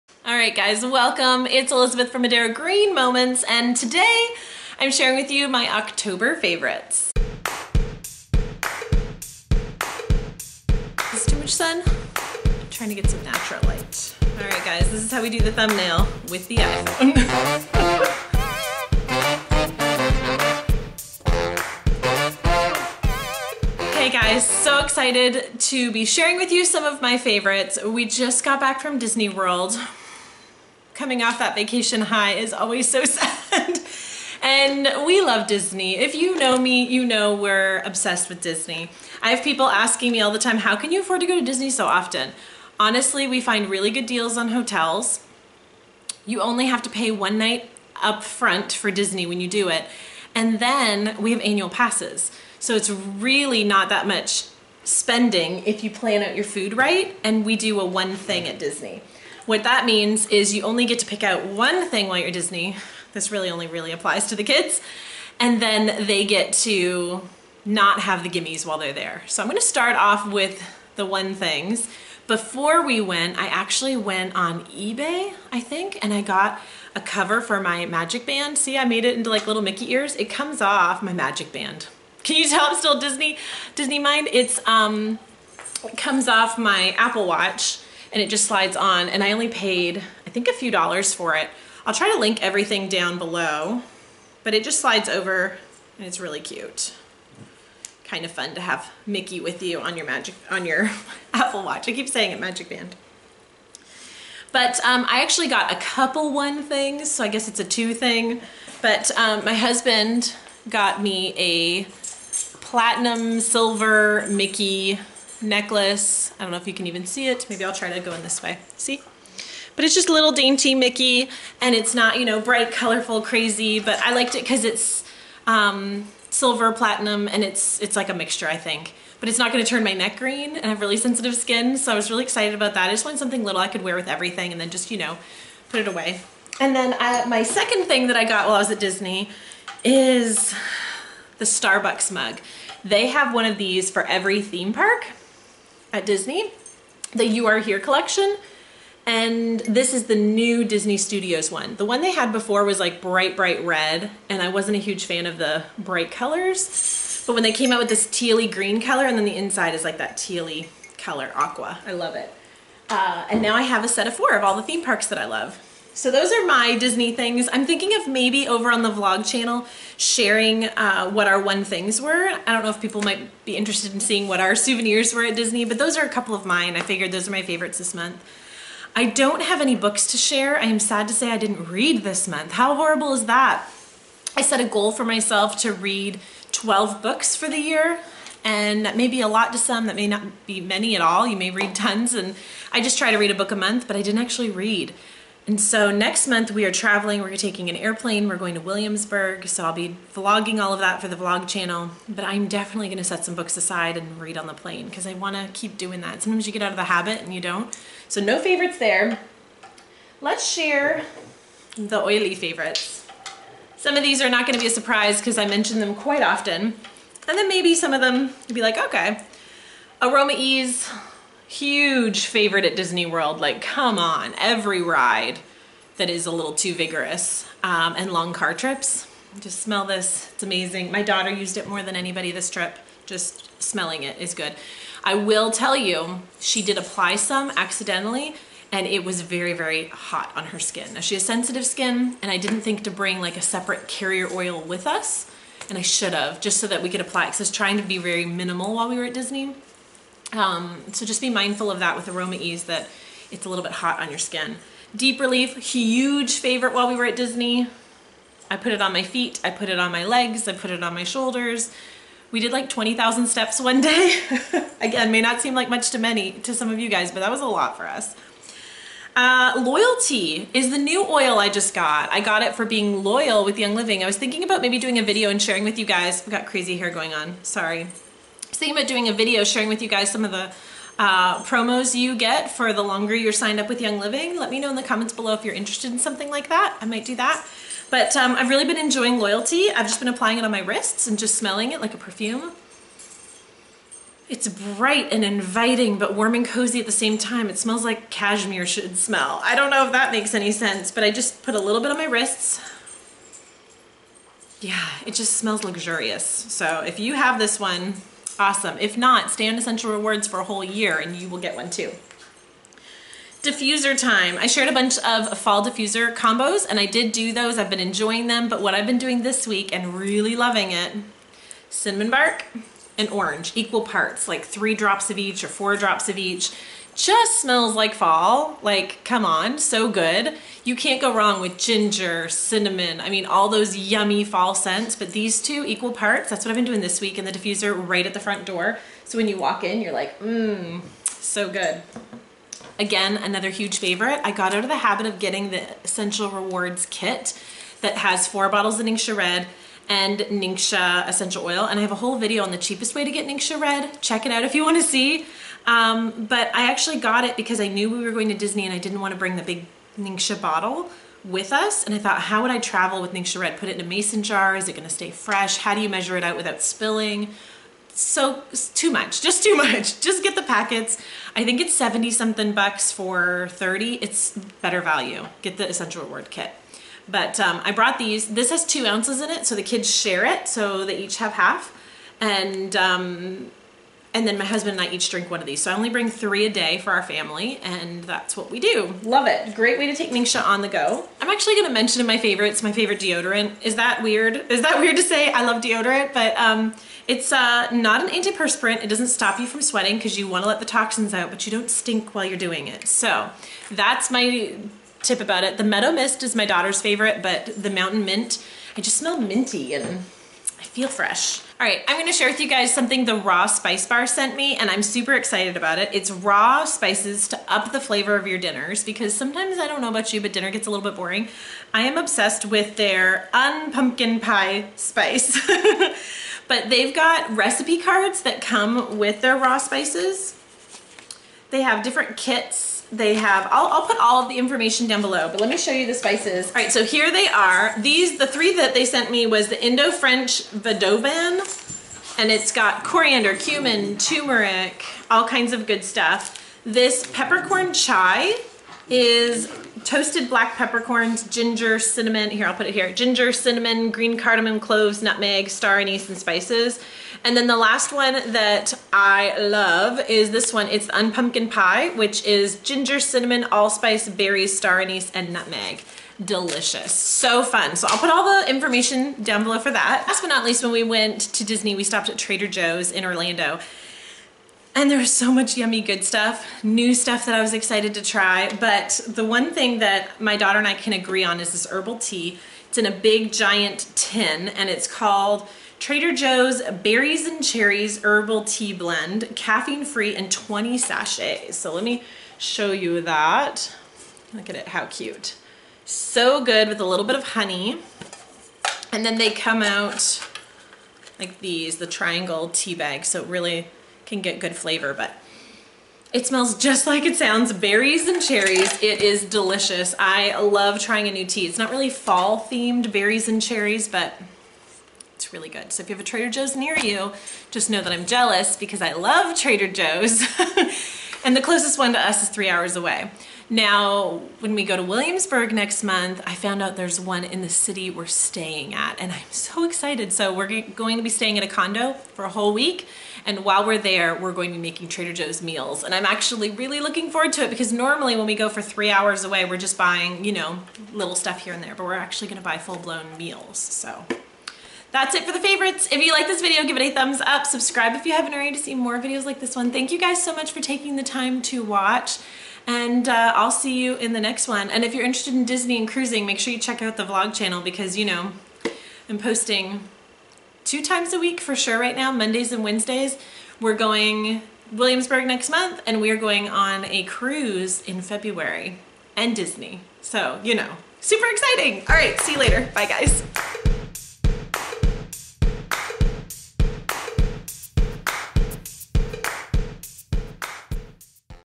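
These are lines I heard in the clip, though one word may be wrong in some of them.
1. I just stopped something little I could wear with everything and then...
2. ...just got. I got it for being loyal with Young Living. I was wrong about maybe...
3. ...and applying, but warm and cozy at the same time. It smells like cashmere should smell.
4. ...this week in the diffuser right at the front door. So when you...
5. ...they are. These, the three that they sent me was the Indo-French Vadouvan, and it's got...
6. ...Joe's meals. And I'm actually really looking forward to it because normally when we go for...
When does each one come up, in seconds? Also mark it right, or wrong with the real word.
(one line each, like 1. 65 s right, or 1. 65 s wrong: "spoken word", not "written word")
1. 132 s wrong: "wanted", not "stopped"
2. 271 s wrong: "thinking", not "wrong"
3. 295 s wrong: "inviting", not "applying"
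4. 336 s right
5. 437 s right
6. 535 s right.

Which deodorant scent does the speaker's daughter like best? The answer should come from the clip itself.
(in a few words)
Meadow Mist.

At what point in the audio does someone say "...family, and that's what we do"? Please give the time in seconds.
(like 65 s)
387 s.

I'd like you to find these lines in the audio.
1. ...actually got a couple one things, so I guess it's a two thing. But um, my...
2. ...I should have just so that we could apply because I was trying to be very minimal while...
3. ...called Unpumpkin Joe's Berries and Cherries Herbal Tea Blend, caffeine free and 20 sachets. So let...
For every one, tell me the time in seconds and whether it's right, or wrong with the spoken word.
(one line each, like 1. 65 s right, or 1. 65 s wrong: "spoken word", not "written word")
1. 105 s right
2. 245 s right
3. 484 s wrong: "Trader", not "Unpumpkin".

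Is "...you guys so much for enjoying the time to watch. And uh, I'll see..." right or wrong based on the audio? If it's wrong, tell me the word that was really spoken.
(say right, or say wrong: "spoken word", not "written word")
wrong: "taking", not "enjoying".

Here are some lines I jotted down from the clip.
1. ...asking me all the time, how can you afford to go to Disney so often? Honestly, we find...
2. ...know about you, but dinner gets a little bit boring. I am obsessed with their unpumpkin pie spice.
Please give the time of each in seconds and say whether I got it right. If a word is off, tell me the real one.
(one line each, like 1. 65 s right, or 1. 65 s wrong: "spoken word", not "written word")
1. 39 s right
2. 419 s right.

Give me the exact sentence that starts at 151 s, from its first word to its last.
The one they had before was like bright, bright red, and I wasn't a huge fan of the bright colors.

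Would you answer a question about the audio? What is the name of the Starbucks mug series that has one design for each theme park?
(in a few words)
You Are Here.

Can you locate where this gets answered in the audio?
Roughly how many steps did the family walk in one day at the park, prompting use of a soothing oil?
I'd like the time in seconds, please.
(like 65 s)
262 s.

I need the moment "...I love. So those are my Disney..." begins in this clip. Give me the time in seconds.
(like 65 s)
165 s.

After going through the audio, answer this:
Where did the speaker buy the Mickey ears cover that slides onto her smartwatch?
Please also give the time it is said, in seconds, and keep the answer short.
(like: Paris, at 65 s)
eBay, at 74 s.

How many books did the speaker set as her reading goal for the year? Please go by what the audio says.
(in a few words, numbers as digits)
12.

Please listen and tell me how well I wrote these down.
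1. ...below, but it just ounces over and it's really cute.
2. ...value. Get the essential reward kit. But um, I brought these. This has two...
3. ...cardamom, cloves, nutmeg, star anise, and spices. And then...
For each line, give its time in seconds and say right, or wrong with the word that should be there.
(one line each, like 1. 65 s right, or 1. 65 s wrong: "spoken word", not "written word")
1. 93 s wrong: "slides", not "ounces"
2. 374 s right
3. 454 s right.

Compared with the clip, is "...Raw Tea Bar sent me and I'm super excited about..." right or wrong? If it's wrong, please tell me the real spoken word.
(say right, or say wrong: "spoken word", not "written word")
wrong: "Spice", not "Tea".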